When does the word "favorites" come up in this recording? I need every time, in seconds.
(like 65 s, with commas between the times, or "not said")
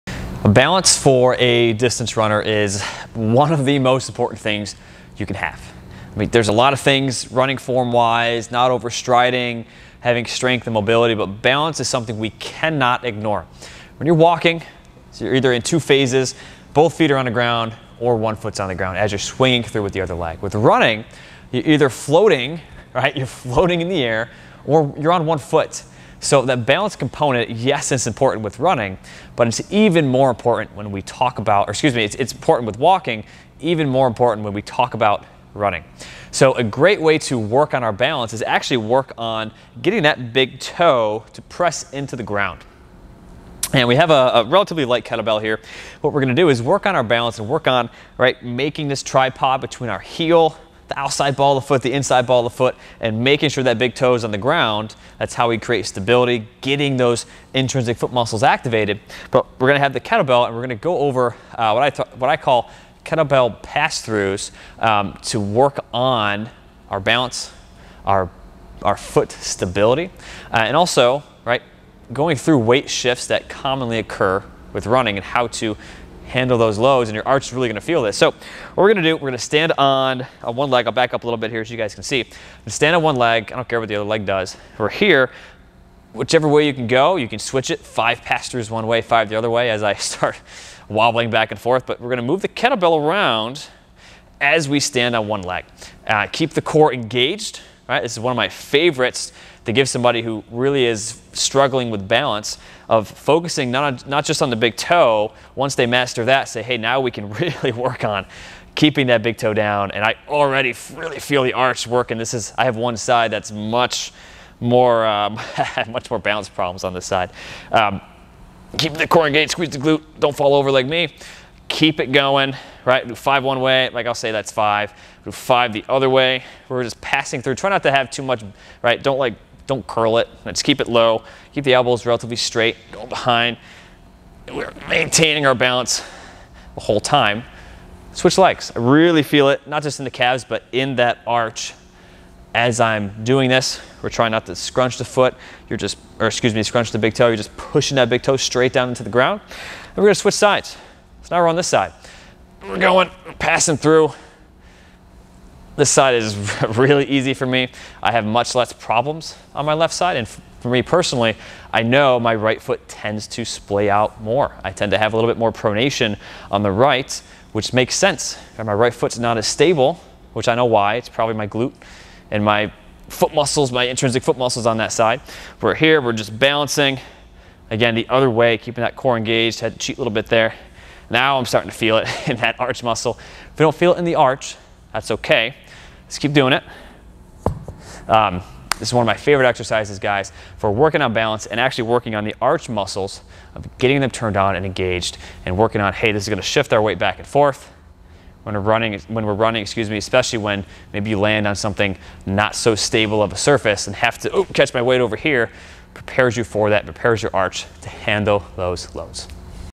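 98 s, 189 s.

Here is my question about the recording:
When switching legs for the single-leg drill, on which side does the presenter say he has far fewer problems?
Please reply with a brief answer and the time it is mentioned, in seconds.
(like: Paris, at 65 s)
Left side, at 159 s.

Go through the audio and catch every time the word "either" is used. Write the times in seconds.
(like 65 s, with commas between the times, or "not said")
15 s, 21 s.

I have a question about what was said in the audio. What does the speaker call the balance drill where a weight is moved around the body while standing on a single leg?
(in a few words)
Kettlebell pass-throughs.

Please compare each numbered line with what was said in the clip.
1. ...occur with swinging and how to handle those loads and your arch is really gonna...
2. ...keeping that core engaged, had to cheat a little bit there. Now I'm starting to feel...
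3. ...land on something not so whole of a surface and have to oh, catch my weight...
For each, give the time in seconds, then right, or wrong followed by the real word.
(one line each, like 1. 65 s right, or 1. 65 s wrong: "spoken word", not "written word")
1. 73 s wrong: "running", not "swinging"
2. 178 s right
3. 201 s wrong: "stable", not "whole".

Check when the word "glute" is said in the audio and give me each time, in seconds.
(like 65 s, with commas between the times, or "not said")
119 s, 171 s.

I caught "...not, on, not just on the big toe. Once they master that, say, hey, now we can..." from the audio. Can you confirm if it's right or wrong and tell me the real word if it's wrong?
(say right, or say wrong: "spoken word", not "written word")
right.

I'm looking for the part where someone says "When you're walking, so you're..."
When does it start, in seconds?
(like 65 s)
13 s.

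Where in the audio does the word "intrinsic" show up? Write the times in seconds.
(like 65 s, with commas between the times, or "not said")
57 s, 173 s.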